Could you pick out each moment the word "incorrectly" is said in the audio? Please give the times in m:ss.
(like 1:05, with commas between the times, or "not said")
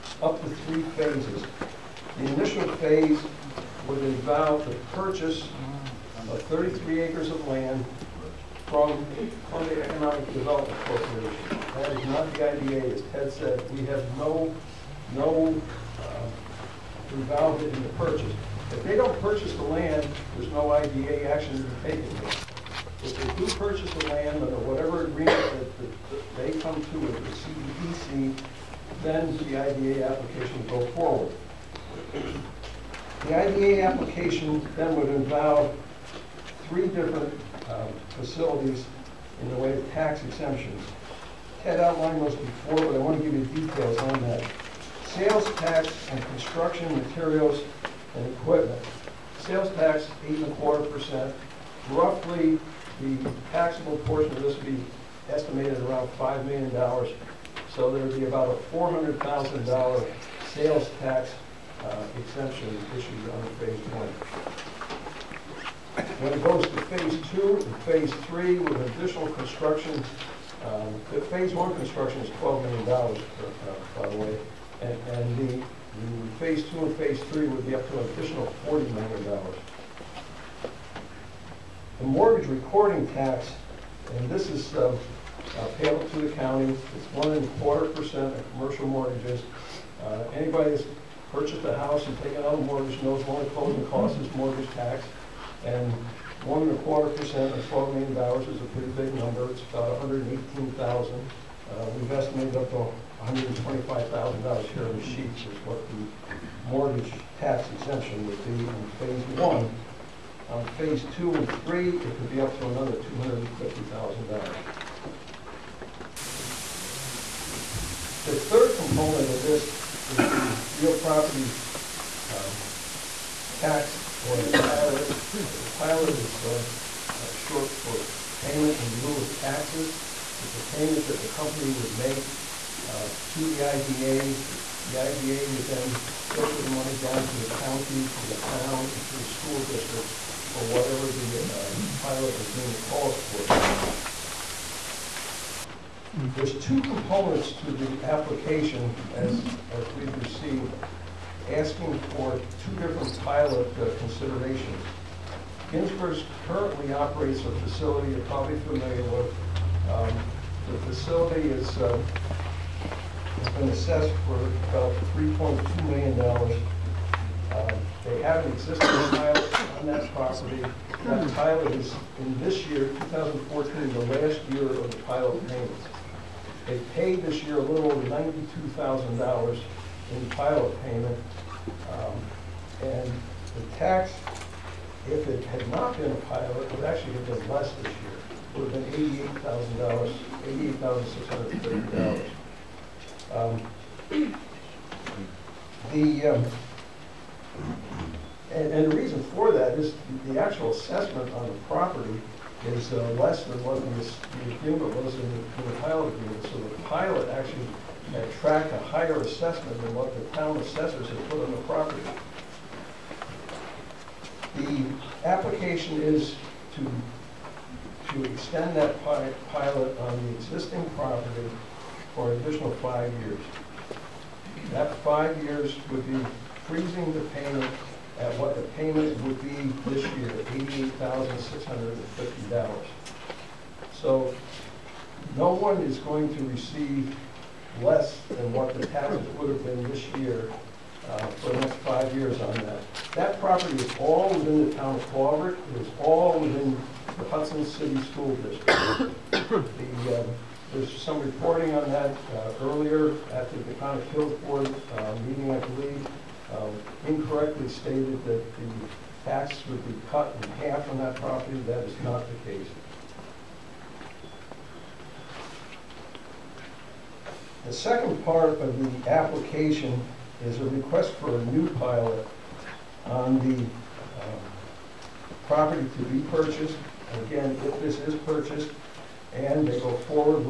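4:17.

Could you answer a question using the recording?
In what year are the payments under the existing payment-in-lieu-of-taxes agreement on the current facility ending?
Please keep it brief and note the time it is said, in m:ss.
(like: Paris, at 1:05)
2014, at 2:52.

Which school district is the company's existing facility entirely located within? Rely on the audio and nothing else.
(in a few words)
Hudson City School District.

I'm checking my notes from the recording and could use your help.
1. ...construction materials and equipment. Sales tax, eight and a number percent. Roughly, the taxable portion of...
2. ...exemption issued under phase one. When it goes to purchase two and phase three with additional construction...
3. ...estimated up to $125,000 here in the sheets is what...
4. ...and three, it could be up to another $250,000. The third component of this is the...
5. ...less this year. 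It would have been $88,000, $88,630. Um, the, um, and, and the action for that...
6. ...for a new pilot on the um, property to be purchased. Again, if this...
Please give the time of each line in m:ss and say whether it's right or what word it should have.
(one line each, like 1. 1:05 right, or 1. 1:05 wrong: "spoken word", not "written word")
1. 0:46 wrong: "quarter", not "number"
2. 1:02 wrong: "phase", not "purchase"
3. 1:42 right
4. 1:51 right
5. 3:07 wrong: "reason", not "action"
6. 4:31 right.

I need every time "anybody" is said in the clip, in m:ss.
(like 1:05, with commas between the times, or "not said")
1:30.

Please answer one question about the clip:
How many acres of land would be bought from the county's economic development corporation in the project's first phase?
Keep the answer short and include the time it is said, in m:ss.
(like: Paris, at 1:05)
33, at 0:06.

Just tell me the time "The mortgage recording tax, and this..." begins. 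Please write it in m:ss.
1:21.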